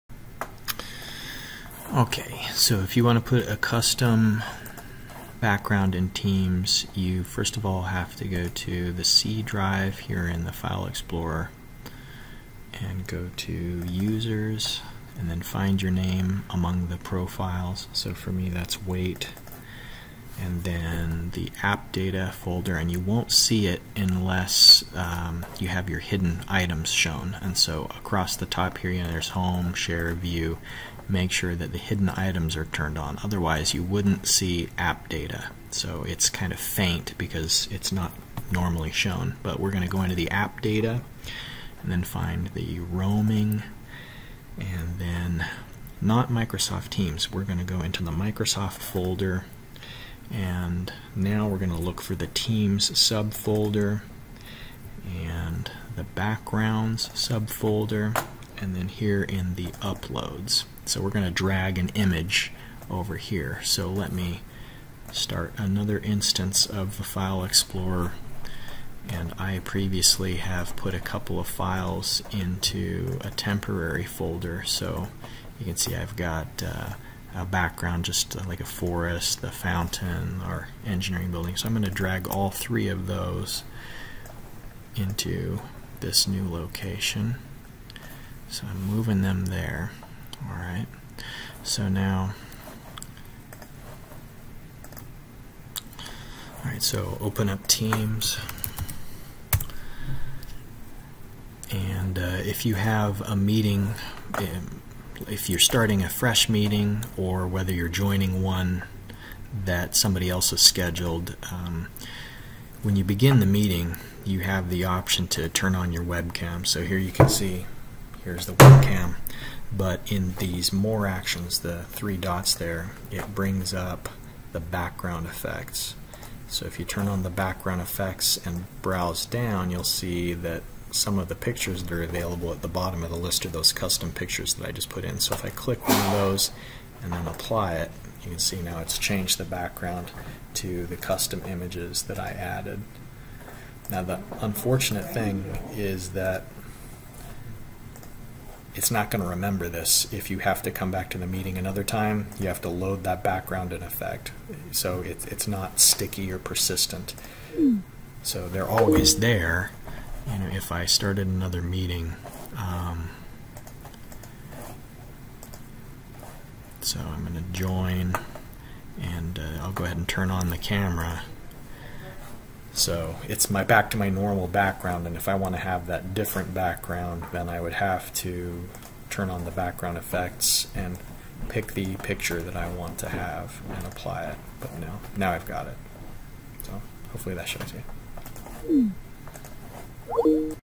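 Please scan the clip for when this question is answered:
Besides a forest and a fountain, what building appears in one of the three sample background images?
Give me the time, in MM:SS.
01:20.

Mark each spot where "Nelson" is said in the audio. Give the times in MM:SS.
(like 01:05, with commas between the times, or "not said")
not said.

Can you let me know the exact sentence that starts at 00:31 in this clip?
Make sure that the hidden items are turned on.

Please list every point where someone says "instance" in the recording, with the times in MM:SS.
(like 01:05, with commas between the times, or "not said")
01:05.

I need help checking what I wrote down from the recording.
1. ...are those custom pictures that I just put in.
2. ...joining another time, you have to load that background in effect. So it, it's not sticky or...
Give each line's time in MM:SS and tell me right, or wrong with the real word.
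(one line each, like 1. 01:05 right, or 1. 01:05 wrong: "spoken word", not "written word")
1. 02:13 right
2. 02:31 wrong: "meeting", not "joining".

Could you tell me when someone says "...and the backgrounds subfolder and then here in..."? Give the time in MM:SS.
00:55.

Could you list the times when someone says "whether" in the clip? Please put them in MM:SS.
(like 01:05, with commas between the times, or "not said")
01:47.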